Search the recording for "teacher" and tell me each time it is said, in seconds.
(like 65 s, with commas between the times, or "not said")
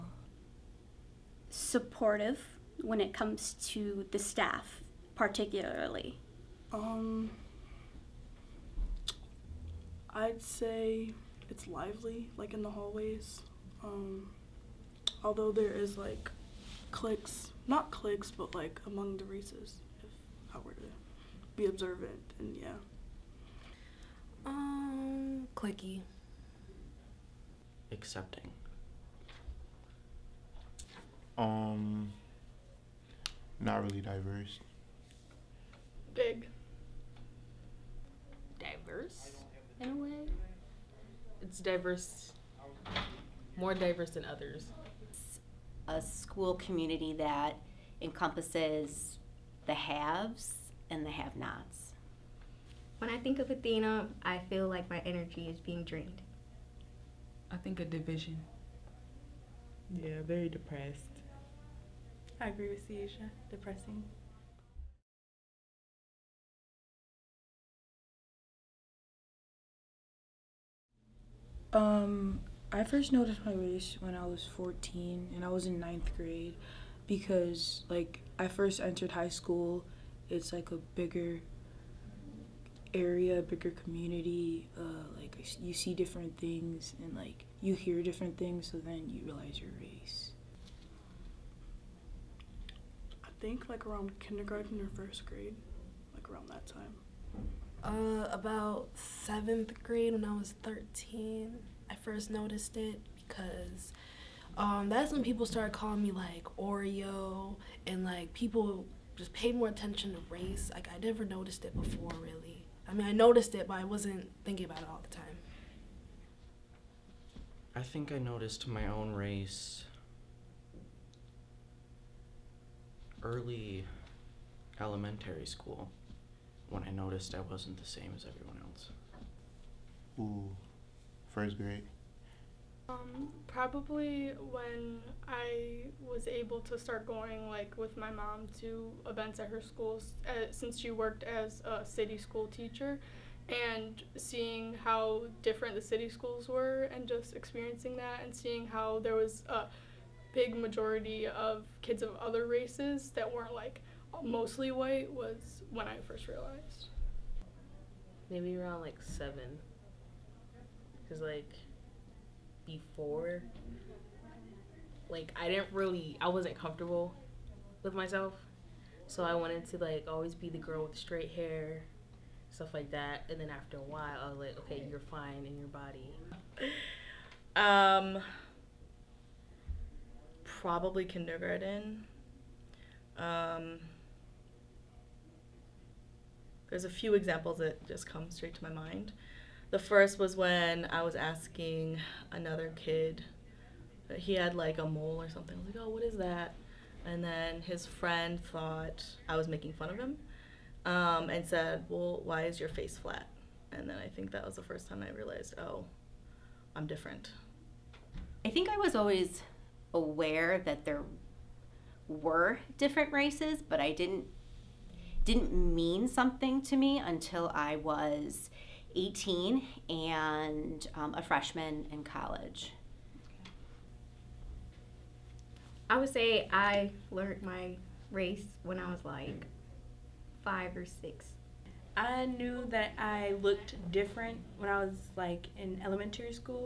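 142 s.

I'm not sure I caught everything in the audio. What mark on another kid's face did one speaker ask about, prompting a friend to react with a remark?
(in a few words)
Mole.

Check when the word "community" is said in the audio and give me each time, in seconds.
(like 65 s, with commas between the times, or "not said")
46 s, 83 s.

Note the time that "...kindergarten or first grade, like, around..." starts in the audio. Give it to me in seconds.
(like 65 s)
94 s.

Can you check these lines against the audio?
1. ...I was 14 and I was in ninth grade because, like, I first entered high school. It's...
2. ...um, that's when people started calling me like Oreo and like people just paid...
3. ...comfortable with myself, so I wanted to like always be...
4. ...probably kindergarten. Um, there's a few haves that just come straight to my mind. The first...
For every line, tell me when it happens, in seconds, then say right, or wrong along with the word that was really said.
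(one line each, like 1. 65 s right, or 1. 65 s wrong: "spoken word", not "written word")
1. 74 s right
2. 104 s right
3. 166 s right
4. 180 s wrong: "examples", not "haves".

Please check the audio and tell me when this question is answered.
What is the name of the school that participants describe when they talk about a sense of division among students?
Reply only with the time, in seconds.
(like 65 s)
53 s.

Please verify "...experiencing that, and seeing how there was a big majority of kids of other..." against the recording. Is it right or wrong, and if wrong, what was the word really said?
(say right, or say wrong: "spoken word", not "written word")
right.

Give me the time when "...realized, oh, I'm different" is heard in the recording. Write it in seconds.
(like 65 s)
205 s.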